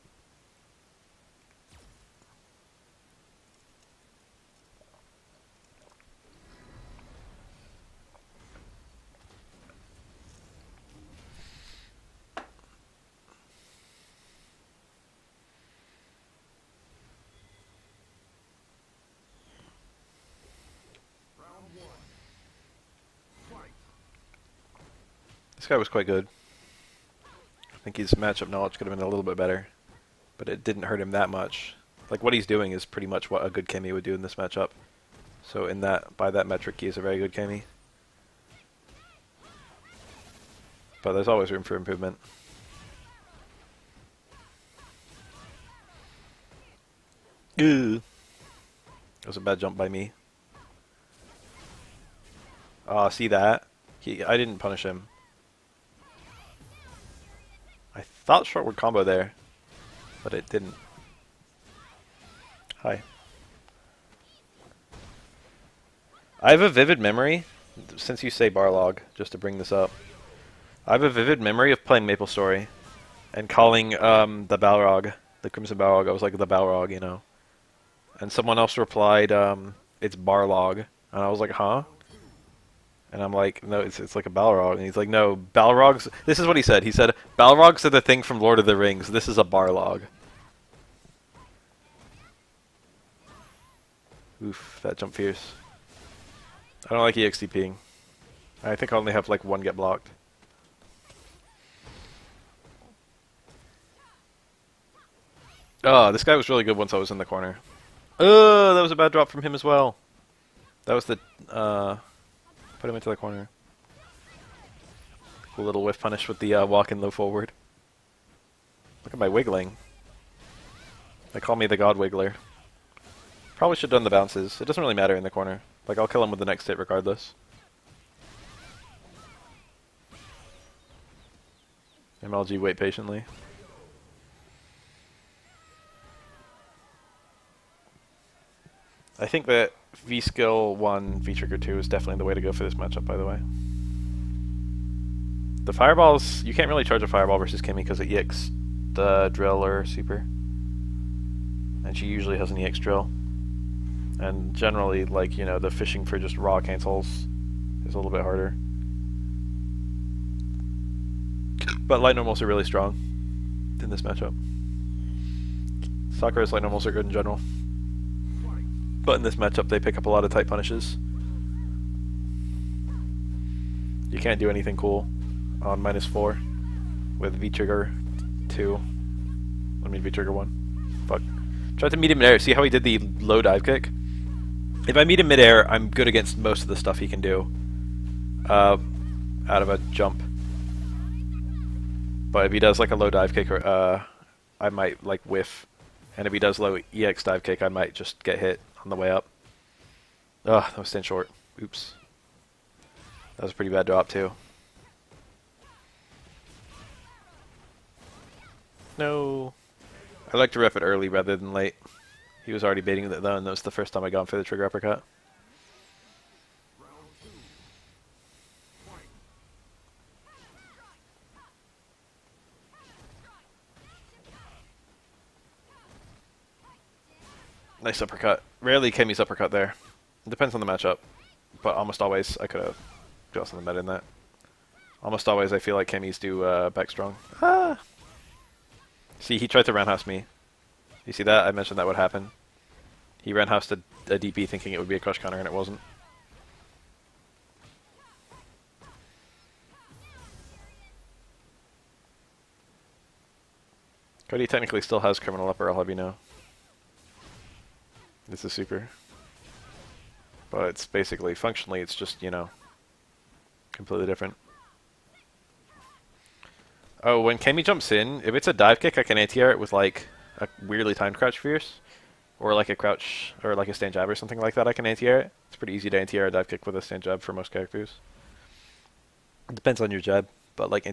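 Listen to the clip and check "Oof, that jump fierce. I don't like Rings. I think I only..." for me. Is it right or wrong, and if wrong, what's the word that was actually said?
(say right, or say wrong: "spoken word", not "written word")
wrong: "EXDPing", not "Rings".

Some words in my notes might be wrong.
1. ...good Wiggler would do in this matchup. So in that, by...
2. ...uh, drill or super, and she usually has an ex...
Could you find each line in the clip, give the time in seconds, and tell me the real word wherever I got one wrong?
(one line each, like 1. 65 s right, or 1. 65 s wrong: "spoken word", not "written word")
1. 33 s wrong: "Cammy", not "Wiggler"
2. 149 s right.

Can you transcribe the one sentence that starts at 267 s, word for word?
Oh, when Cammy jumps in, if it's a dive kick, I can anti-air it with, like, a weirdly timed crouch fierce.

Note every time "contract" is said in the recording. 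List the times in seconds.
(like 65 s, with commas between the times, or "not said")
not said.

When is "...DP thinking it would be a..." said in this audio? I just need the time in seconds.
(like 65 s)
244 s.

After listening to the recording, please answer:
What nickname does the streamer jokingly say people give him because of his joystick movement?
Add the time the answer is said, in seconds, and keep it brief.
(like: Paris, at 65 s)
The God Wiggler, at 121 s.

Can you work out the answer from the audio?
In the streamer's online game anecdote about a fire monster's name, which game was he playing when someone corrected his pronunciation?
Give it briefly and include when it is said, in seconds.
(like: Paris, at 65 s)
Maple Story, at 72 s.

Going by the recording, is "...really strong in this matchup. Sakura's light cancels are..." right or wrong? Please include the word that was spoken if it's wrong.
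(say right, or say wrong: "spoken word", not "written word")
wrong: "normals", not "cancels".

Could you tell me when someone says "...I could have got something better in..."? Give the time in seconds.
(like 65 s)
232 s.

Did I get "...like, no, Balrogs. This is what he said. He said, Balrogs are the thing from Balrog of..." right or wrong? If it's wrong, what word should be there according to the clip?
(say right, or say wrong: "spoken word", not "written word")
wrong: "Lord", not "Balrog".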